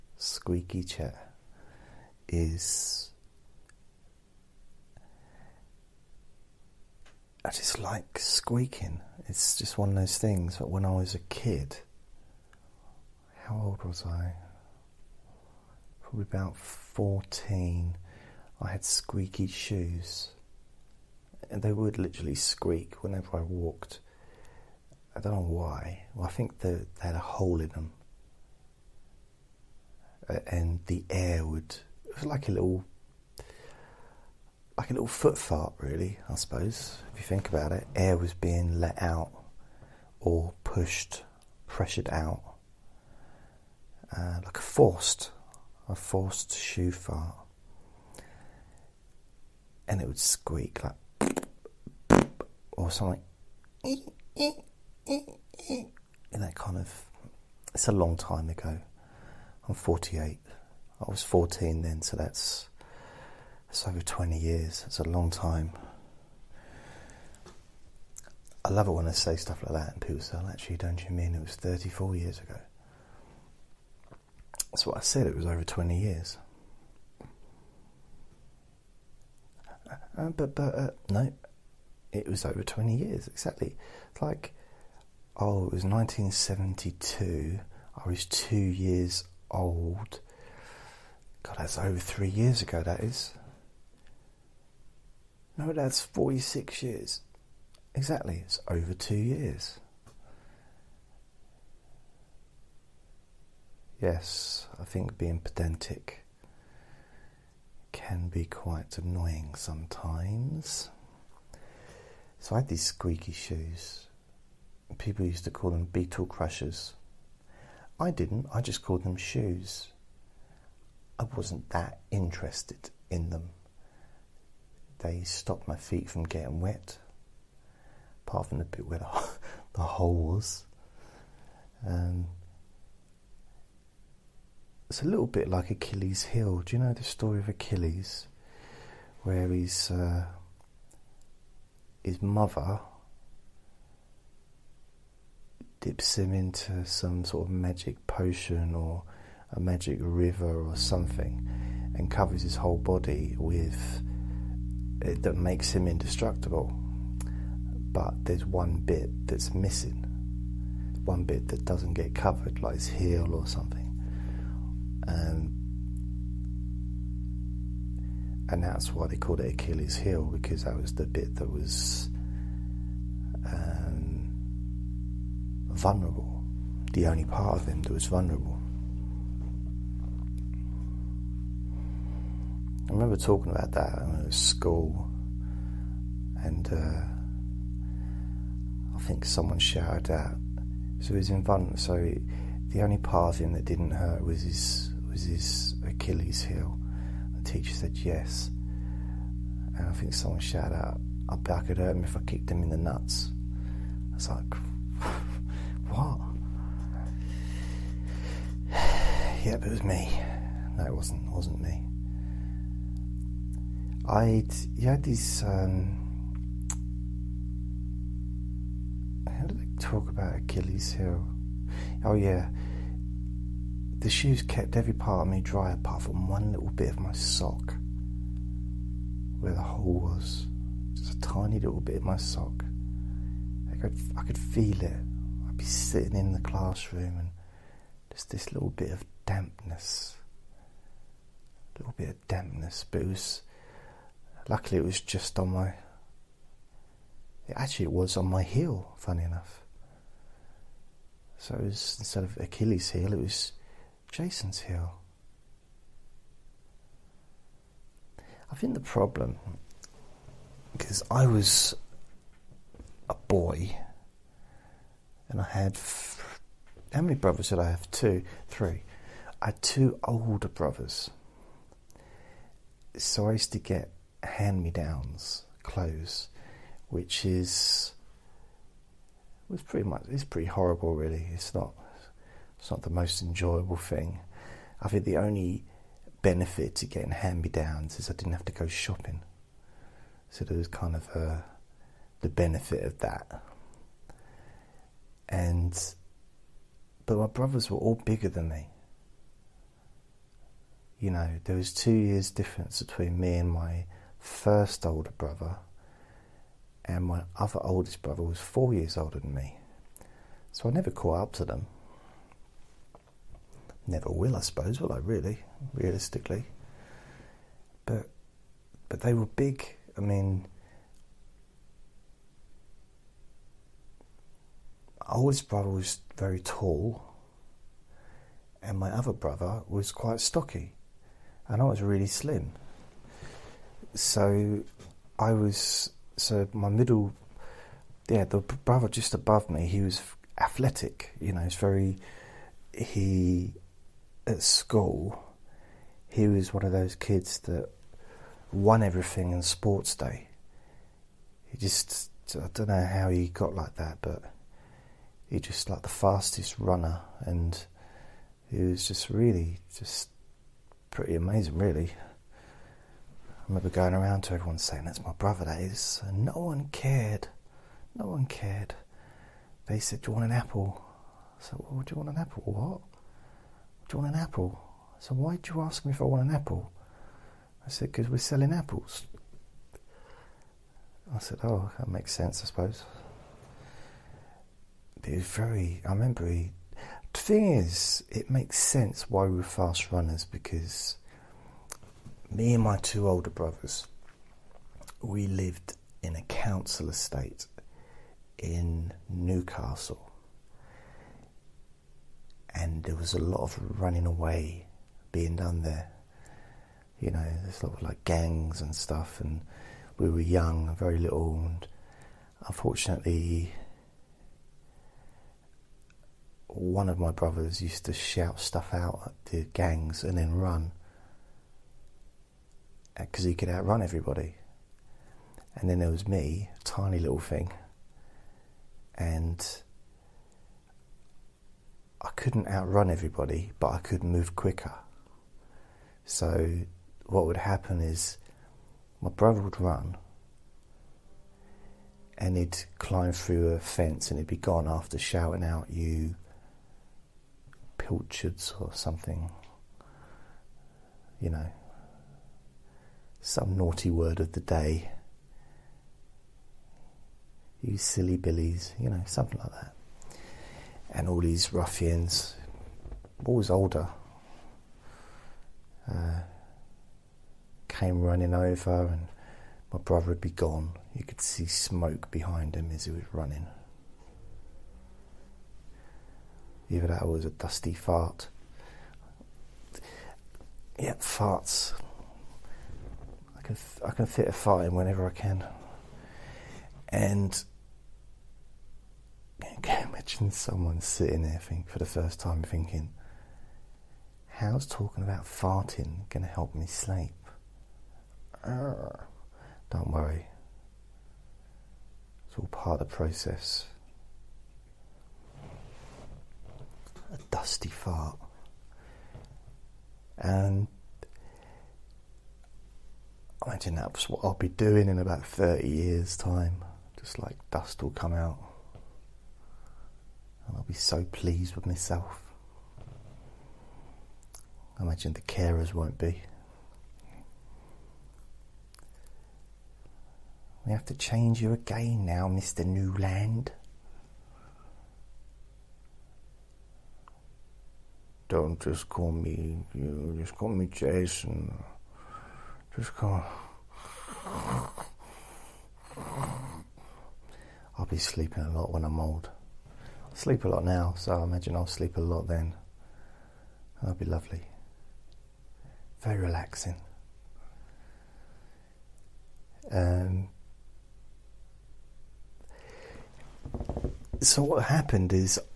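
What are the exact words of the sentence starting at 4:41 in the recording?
It's not it's not the most enjoyable thing.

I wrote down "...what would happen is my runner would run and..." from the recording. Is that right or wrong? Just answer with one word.
wrong.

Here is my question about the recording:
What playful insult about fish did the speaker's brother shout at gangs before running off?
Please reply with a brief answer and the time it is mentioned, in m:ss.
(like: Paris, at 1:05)
pilchards, at 7:25.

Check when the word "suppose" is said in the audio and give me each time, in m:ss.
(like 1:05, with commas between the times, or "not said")
0:36, 5:14, 6:22.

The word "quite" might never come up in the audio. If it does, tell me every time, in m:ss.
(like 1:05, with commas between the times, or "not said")
1:48, 5:29.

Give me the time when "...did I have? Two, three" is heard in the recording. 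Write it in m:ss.
4:27.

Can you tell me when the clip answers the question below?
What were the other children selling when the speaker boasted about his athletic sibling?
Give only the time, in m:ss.
6:18.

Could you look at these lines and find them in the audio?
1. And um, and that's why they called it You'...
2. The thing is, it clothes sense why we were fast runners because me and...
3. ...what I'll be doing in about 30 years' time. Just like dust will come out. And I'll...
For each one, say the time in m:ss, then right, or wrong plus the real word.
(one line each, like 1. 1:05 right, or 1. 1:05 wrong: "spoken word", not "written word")
1. 2:45 wrong: "Achilles", not "You"
2. 6:27 wrong: "makes", not "clothes"
3. 8:34 right.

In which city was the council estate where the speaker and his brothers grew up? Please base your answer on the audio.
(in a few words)
Newcastle.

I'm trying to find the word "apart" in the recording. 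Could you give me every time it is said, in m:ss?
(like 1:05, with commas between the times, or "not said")
2:08, 3:45.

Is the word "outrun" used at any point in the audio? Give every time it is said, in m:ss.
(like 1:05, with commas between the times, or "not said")
7:03, 7:12.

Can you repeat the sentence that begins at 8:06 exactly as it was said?
And I can imagine someone sitting there think, for the first time thinking, how's talking about farting going to help me sleep?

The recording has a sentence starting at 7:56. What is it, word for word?
Even that was a dusty fart.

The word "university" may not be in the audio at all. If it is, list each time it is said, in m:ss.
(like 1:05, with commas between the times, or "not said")
not said.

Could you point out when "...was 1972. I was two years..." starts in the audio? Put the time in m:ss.
1:25.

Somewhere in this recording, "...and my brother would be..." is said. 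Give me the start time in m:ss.
7:48.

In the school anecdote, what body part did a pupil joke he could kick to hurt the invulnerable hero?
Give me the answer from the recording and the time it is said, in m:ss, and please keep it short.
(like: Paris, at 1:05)
the nuts, at 3:22.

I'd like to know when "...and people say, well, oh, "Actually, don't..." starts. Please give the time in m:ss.
1:09.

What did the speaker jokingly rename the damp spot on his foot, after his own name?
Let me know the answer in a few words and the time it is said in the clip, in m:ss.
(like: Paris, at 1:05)
Jason's heel, at 4:14.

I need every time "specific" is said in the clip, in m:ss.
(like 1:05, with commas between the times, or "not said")
not said.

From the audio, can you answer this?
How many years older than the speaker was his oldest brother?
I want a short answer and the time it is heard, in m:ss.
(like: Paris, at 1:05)
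4, at 5:08.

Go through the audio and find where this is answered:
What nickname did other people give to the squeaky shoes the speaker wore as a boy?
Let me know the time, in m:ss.
1:55.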